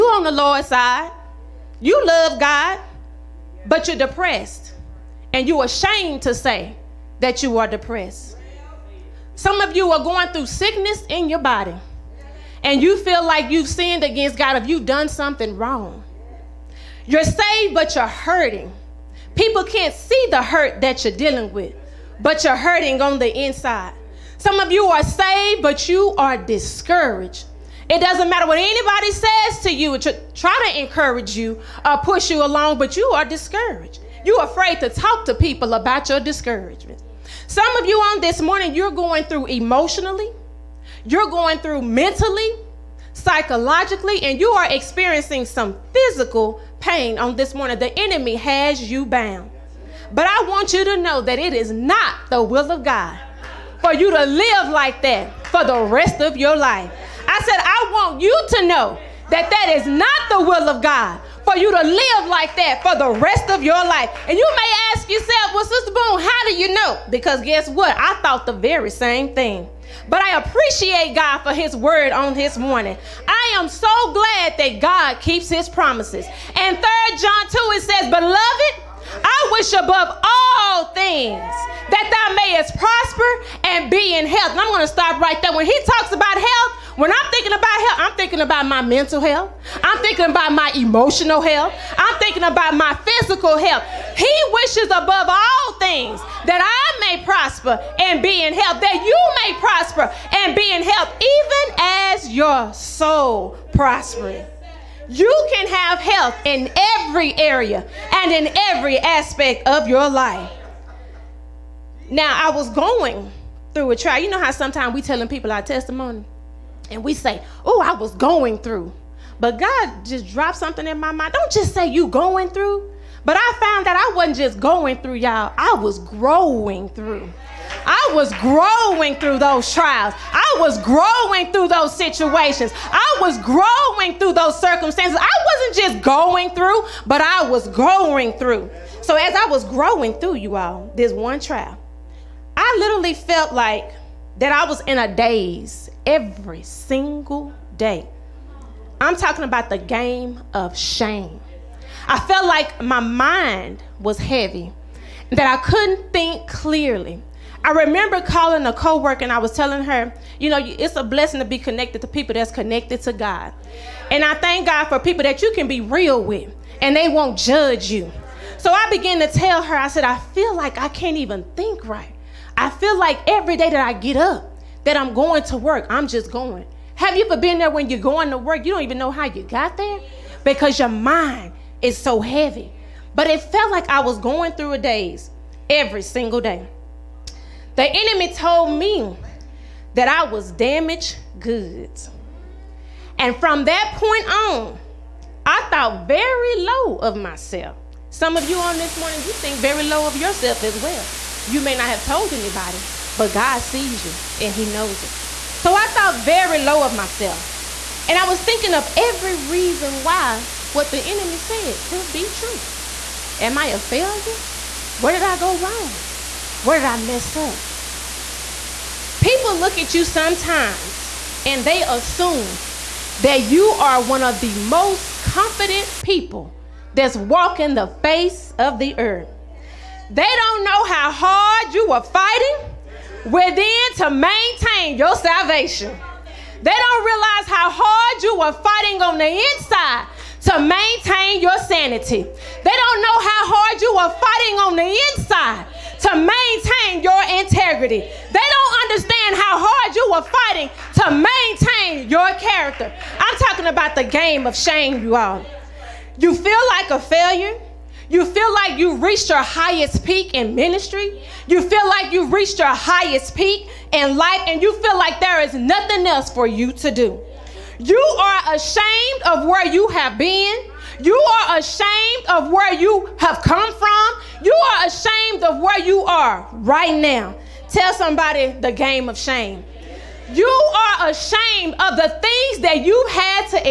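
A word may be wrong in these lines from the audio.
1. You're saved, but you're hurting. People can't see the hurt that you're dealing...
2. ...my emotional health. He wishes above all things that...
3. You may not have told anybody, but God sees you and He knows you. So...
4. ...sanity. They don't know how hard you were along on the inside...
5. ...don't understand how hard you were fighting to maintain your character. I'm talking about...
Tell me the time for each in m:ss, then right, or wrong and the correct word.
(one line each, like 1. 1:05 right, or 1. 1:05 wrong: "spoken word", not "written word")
1. 0:17 right
2. 1:32 wrong: "physical", not "emotional"
3. 3:21 right
4. 4:01 wrong: "fighting", not "along"
5. 4:08 right.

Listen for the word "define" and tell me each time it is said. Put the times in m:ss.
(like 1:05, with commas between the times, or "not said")
not said.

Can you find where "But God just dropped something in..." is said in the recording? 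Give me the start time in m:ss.
1:59.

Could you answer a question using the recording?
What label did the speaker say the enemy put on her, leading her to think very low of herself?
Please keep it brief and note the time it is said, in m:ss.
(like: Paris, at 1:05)
damaged goods, at 3:10.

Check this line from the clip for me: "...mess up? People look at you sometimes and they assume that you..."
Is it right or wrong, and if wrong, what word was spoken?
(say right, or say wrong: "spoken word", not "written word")
right.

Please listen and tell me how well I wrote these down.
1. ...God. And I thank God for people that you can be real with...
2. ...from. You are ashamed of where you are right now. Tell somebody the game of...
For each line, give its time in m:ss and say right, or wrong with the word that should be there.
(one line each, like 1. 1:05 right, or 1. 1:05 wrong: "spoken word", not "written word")
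1. 2:43 right
2. 4:33 right.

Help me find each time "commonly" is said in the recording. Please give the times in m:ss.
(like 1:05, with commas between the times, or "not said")
not said.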